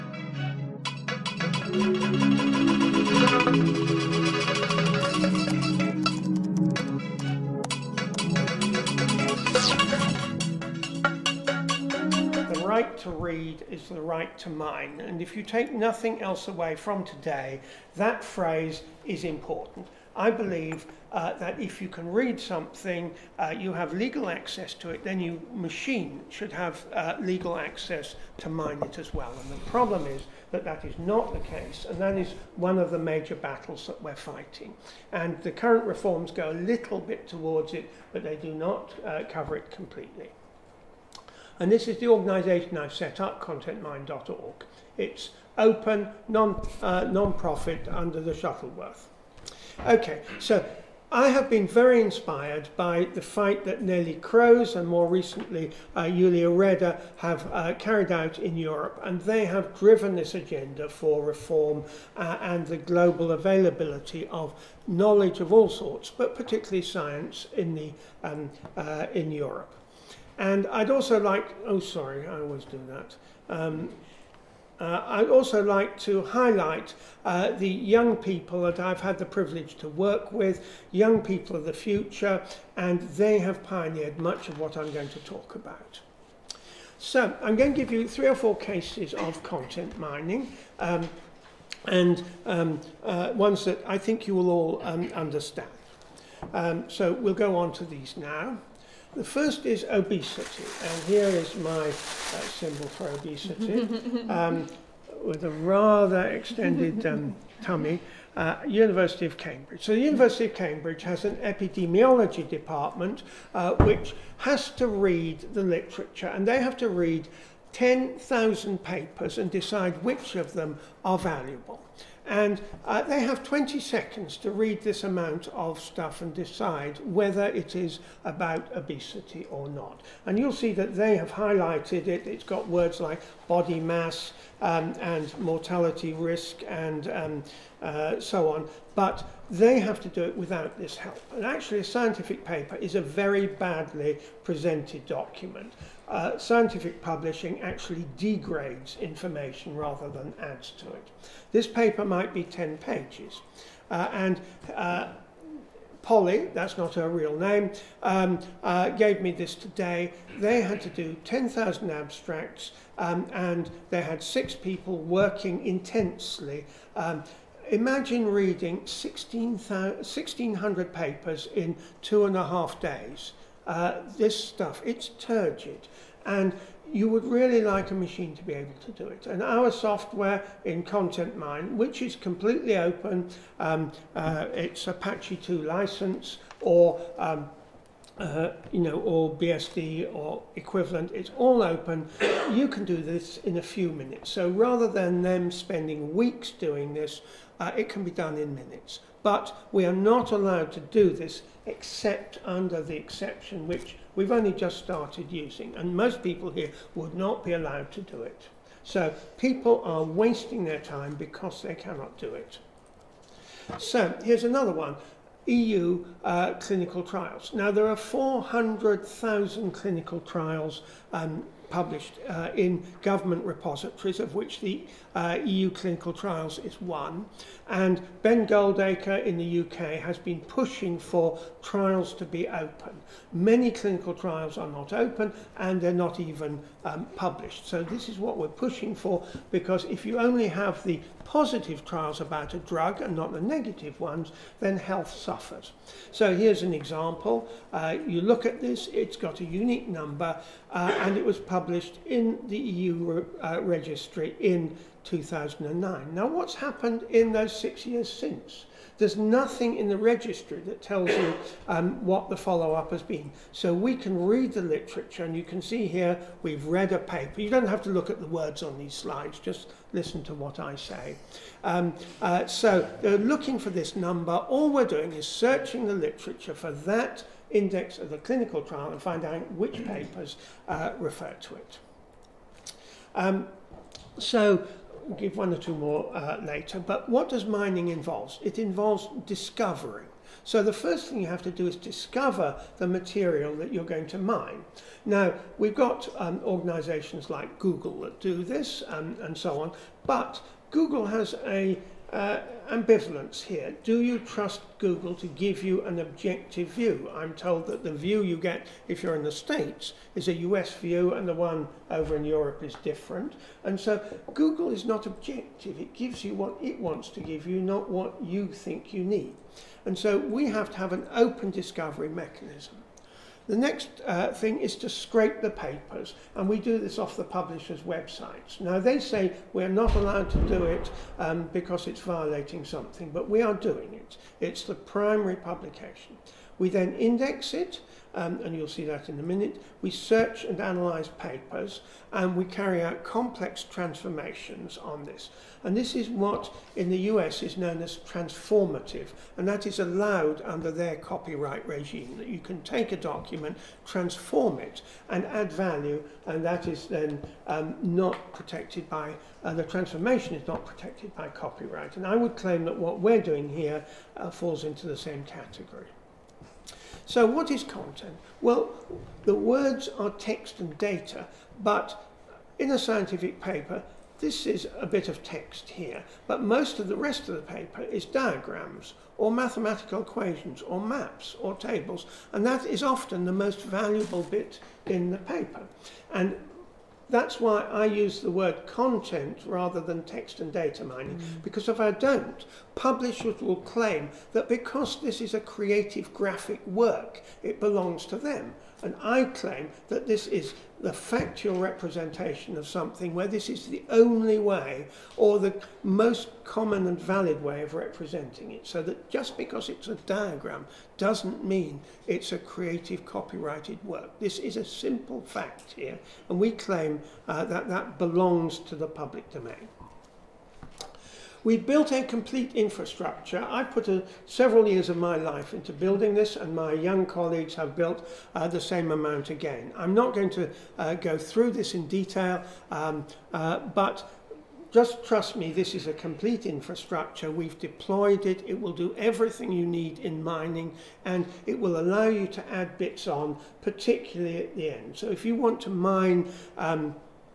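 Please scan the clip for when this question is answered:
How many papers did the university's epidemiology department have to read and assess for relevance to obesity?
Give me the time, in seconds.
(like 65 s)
117 s.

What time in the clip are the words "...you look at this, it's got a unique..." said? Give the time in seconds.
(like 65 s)
248 s.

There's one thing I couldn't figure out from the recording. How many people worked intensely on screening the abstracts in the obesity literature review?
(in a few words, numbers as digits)
6.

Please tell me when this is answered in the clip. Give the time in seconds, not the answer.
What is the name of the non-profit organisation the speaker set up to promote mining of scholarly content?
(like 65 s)
43 s.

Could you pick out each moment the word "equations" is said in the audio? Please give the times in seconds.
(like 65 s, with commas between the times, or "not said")
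380 s.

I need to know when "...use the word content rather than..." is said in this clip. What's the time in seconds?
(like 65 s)
387 s.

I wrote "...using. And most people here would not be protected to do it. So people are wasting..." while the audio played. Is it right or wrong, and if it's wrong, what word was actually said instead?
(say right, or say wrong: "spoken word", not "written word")
wrong: "allowed", not "protected".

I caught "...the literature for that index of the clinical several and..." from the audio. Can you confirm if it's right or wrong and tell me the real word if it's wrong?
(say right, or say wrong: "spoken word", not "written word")
wrong: "trial", not "several".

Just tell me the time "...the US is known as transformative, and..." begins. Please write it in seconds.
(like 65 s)
346 s.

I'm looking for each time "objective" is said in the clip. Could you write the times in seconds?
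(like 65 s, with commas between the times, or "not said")
305 s, 315 s.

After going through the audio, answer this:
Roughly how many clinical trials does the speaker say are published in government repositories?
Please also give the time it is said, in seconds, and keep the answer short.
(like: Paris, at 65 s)
400,000, at 217 s.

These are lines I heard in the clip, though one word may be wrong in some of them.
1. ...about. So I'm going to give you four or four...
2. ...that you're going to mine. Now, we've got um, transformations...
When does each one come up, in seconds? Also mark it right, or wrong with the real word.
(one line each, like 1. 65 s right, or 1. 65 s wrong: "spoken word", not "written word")
1. 85 s wrong: "three", not "four"
2. 293 s wrong: "organizations", not "transformations".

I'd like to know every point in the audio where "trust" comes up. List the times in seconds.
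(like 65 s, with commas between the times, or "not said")
304 s, 435 s.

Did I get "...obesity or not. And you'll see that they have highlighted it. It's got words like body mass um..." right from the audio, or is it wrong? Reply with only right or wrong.
right.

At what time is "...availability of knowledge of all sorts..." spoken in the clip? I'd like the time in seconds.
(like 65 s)
63 s.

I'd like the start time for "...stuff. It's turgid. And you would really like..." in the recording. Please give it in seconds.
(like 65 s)
174 s.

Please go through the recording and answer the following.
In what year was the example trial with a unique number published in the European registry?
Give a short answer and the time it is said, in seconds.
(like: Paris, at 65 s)
2009, at 255 s.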